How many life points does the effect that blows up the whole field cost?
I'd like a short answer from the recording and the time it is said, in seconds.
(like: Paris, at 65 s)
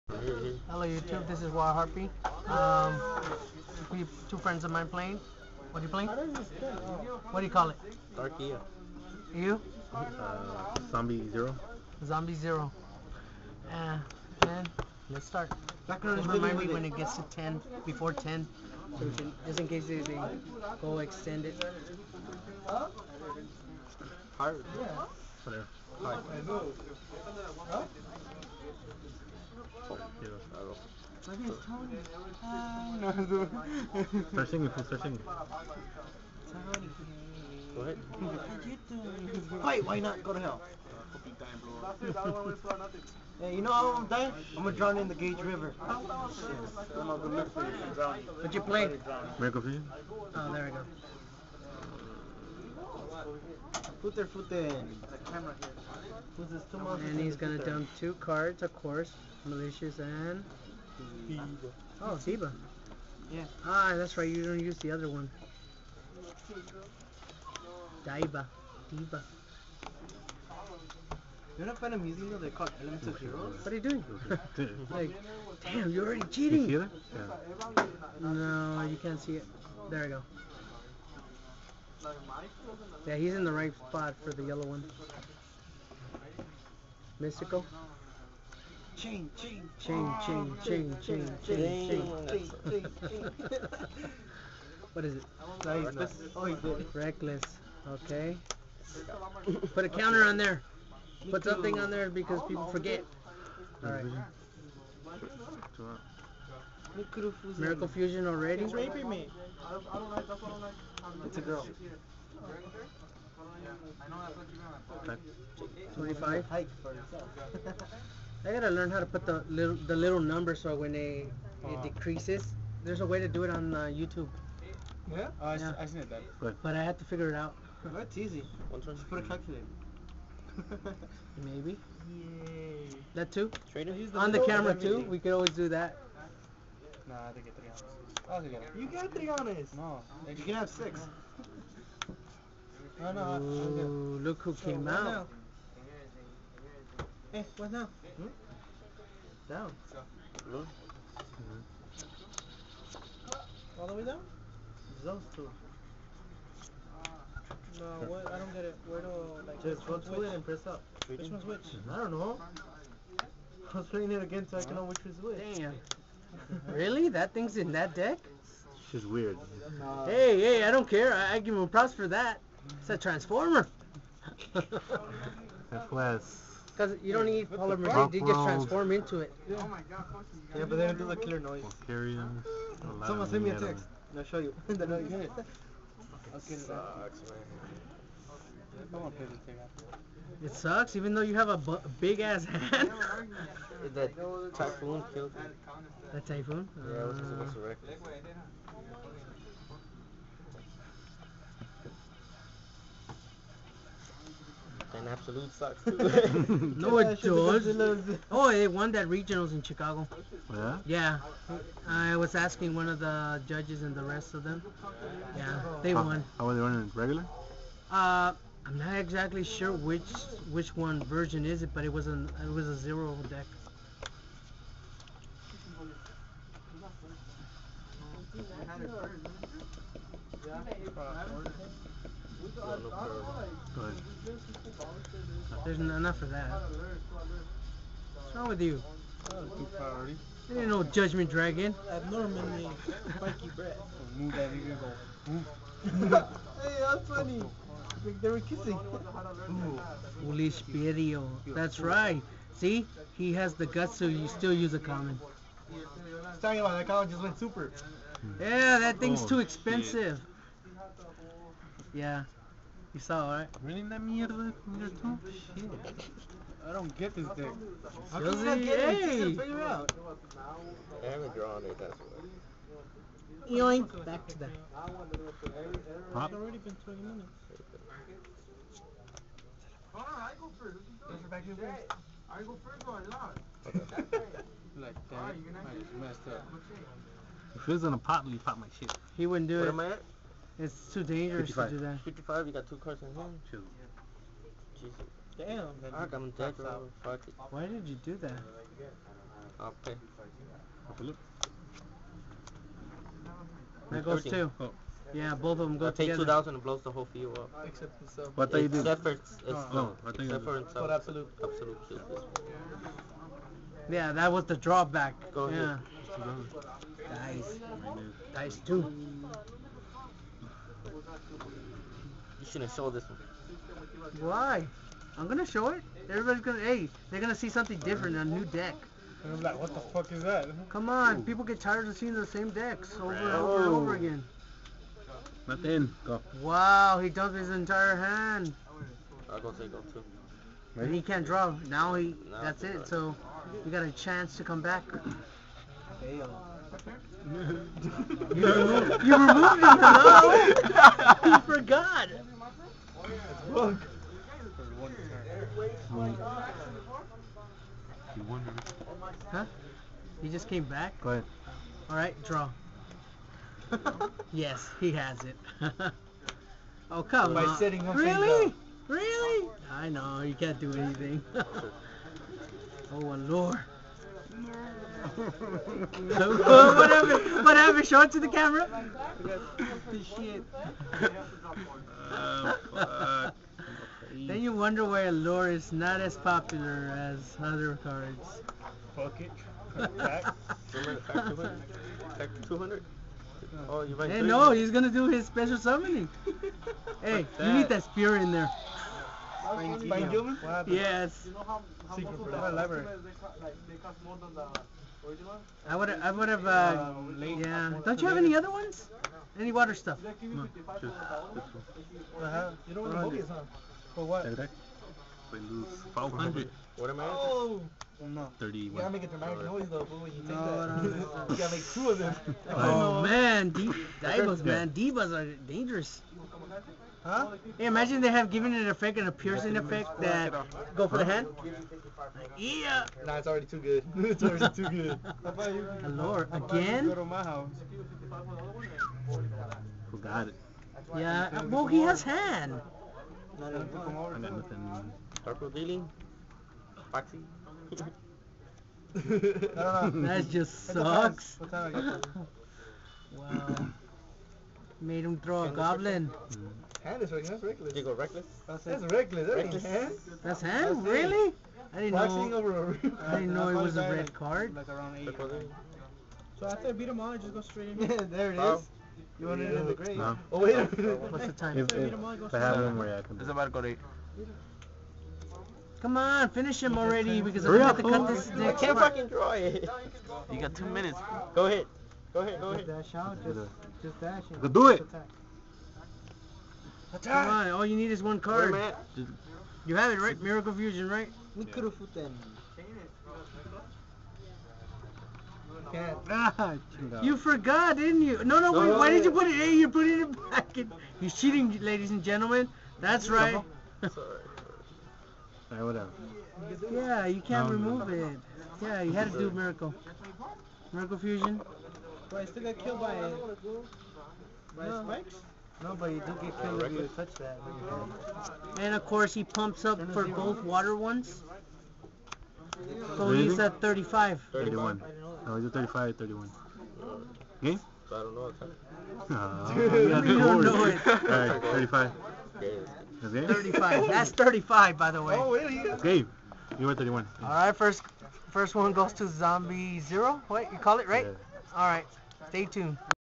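2,000, at 306 s.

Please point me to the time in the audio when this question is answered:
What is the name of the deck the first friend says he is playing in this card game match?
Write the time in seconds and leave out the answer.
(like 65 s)
8 s.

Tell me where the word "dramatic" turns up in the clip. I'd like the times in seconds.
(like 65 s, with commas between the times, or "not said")
419 s.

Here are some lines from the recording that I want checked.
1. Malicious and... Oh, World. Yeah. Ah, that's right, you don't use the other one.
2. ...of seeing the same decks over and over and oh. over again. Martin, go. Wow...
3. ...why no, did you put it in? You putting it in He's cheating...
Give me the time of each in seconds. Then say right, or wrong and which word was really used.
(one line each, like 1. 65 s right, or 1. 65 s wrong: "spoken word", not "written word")
1. 59 s wrong: "Ziba", not "World"
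2. 331 s right
3. 498 s right.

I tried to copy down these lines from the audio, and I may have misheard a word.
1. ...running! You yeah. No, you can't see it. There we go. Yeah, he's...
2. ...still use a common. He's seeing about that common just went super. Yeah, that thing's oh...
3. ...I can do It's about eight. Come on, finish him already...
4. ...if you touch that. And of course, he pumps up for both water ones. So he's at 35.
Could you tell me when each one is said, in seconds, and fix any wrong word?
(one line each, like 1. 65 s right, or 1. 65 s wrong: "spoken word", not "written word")
1. 76 s wrong: "cheating", not "running"
2. 254 s wrong: "talking", not "seeing"
3. 472 s right
4. 516 s right.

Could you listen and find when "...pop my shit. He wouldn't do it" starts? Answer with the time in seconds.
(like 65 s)
288 s.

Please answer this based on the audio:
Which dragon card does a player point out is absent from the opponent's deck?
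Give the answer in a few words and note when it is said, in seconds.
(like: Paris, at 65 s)
judgment dragon, at 240 s.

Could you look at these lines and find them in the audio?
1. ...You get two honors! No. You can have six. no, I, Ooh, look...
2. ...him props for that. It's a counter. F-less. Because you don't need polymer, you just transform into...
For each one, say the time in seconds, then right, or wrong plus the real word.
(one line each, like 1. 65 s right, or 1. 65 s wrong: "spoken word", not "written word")
1. 138 s wrong: "three", not "two"
2. 171 s wrong: "transformer", not "counter".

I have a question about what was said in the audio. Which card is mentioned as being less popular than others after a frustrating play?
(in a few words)
Allure.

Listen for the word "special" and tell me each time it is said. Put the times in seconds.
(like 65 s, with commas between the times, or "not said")
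395 s.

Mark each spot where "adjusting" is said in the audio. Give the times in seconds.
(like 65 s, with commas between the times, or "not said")
not said.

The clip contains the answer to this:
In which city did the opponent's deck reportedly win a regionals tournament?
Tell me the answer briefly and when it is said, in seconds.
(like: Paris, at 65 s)
Chicago, at 209 s.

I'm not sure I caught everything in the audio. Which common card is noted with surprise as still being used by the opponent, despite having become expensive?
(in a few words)
Foolish Burial.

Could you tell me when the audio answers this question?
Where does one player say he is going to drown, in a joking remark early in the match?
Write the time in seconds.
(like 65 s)
45 s.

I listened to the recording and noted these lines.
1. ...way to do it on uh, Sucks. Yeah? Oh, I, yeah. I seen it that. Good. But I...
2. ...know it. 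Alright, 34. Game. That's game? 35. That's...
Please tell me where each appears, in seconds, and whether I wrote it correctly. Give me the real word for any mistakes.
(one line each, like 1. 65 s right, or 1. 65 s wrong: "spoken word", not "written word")
1. 123 s wrong: "YouTube", not "Sucks"
2. 530 s wrong: "35", not "34".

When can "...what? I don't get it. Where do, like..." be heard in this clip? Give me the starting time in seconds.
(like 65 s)
158 s.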